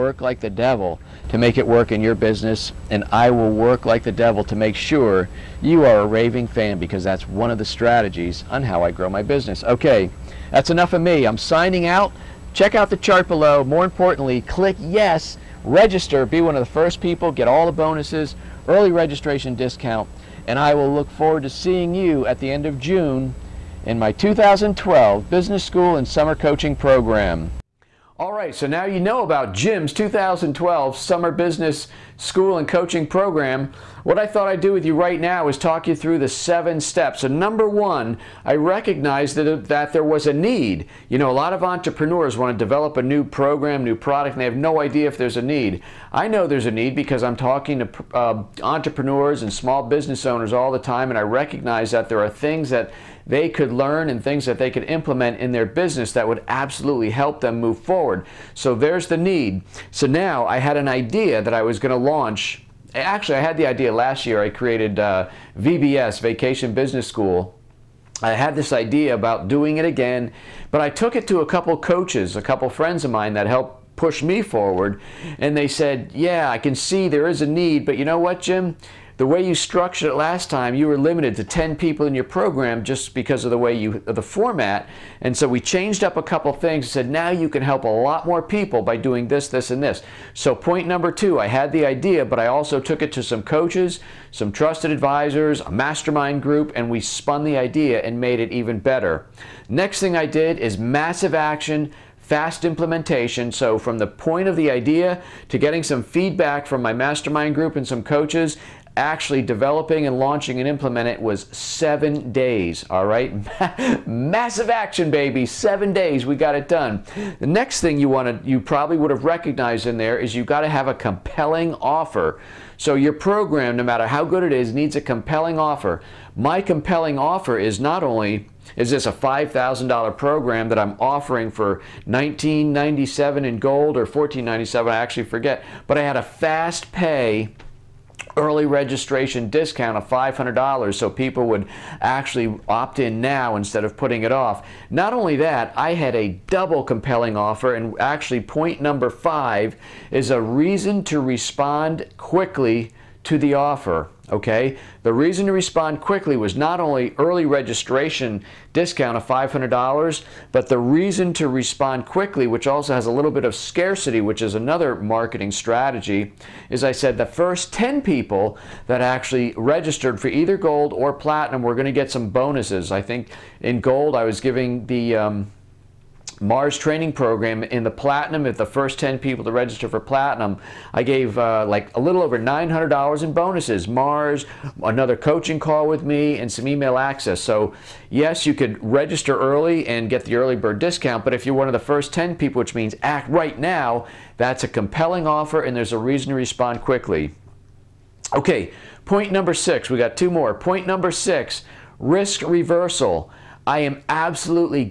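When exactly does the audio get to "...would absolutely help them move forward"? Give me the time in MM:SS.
00:56.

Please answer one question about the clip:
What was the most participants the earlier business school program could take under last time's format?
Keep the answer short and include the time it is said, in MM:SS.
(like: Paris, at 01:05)
10, at 01:21.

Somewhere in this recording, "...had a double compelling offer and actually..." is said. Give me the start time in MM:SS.
02:25.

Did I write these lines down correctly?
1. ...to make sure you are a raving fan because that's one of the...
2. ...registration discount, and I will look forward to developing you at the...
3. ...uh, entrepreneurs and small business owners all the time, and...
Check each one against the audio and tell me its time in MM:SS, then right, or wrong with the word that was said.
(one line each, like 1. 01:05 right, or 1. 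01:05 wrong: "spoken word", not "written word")
1. 00:04 right
2. 00:18 wrong: "seeing", not "developing"
3. 00:48 right.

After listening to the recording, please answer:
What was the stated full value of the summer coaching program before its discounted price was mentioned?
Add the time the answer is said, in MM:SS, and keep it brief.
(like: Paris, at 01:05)
$5,000, at 02:09.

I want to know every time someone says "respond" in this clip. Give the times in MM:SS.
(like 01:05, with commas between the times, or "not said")
02:31, 02:35, 02:41, 03:16.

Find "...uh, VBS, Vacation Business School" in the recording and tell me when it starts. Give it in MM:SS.
01:04.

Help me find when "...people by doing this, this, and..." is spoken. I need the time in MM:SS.
01:28.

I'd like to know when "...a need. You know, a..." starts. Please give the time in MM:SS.
00:40.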